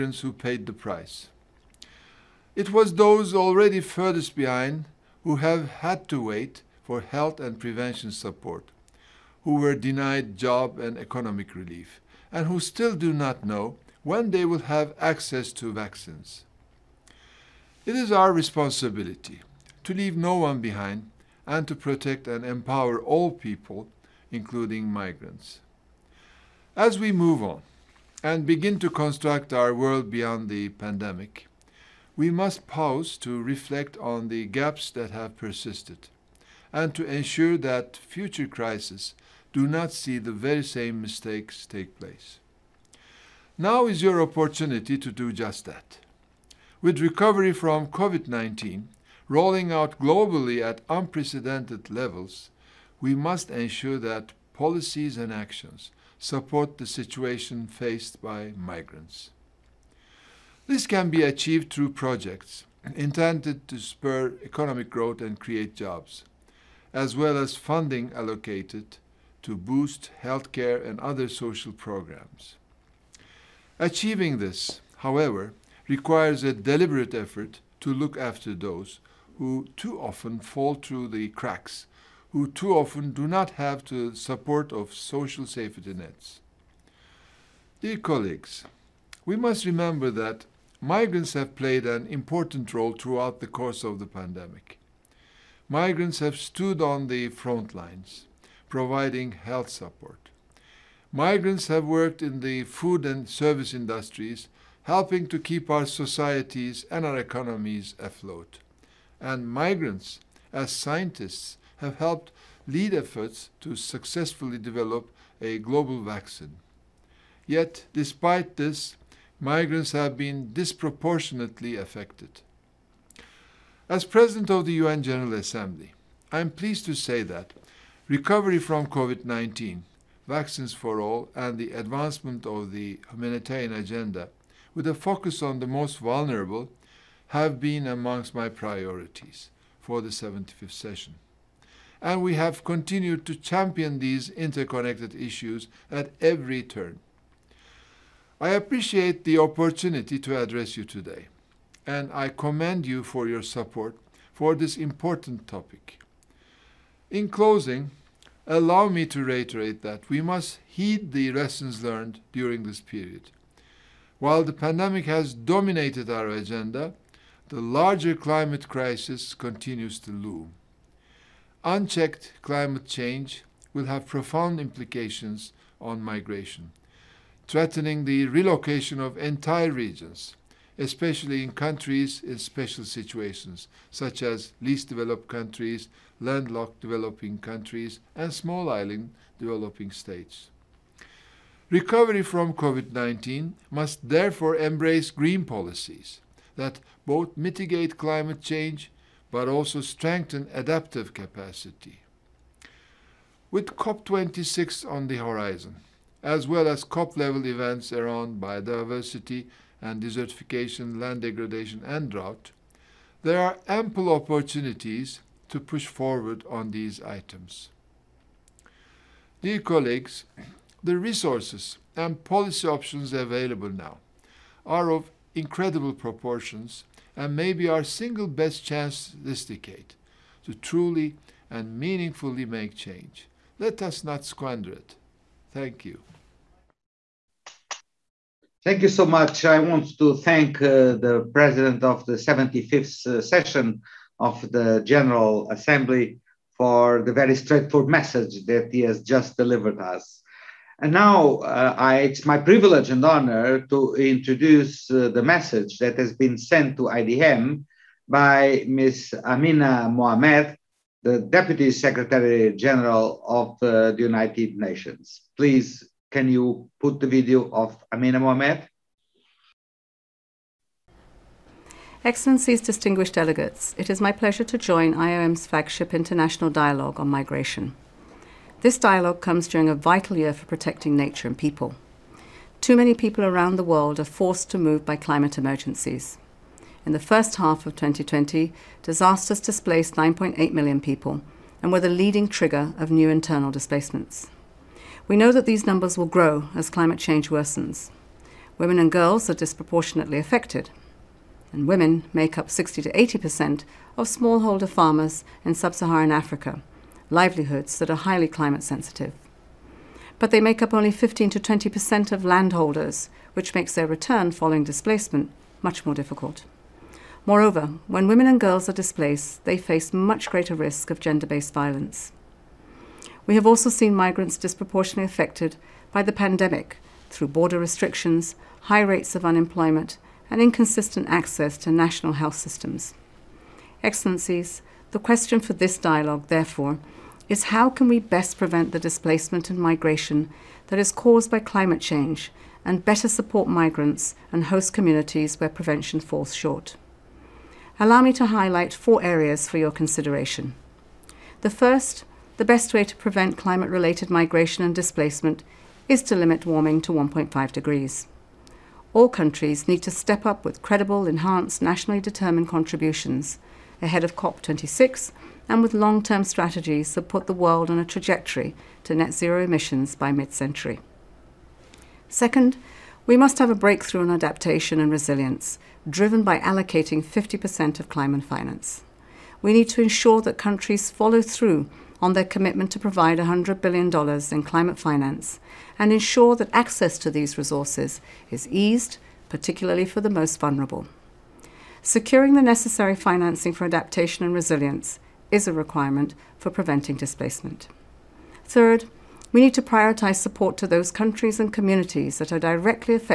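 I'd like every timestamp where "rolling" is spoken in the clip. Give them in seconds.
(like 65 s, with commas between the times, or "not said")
49 s.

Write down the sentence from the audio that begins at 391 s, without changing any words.
Securing the necessary financing for adaptation and resilience is a requirement for preventing displacement.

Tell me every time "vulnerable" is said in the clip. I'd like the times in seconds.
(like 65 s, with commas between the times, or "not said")
135 s, 390 s.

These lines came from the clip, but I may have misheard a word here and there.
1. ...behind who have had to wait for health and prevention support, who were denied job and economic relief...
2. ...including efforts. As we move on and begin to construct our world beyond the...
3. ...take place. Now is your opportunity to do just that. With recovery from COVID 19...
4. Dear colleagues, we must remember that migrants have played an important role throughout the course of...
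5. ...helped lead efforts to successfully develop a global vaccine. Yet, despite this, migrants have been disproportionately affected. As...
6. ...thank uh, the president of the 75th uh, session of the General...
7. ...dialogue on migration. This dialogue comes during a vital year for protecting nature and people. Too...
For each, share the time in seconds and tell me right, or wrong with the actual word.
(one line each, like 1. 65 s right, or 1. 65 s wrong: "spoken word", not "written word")
1. 4 s right
2. 24 s wrong: "migrants", not "efforts"
3. 41 s right
4. 87 s right
5. 111 s right
6. 240 s right
7. 276 s right.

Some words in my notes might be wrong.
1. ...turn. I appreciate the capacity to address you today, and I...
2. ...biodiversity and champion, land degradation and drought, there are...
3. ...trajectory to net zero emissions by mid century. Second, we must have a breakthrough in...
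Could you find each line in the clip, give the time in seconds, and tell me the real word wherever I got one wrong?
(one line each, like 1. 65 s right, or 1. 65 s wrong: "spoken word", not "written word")
1. 146 s wrong: "opportunity", not "capacity"
2. 208 s wrong: "desertification", not "champion"
3. 367 s right.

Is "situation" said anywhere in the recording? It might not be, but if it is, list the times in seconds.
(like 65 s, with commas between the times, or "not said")
56 s, 182 s.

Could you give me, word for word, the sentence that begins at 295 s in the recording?
We know that these numbers will grow as climate change worsens.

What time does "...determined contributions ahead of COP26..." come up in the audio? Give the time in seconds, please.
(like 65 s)
361 s.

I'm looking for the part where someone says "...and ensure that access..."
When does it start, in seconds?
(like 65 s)
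385 s.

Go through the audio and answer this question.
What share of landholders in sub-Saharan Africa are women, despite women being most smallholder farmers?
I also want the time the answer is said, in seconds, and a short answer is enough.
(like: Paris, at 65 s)
15 to 20 percent, at 310 s.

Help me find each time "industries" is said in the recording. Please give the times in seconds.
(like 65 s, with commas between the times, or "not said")
103 s.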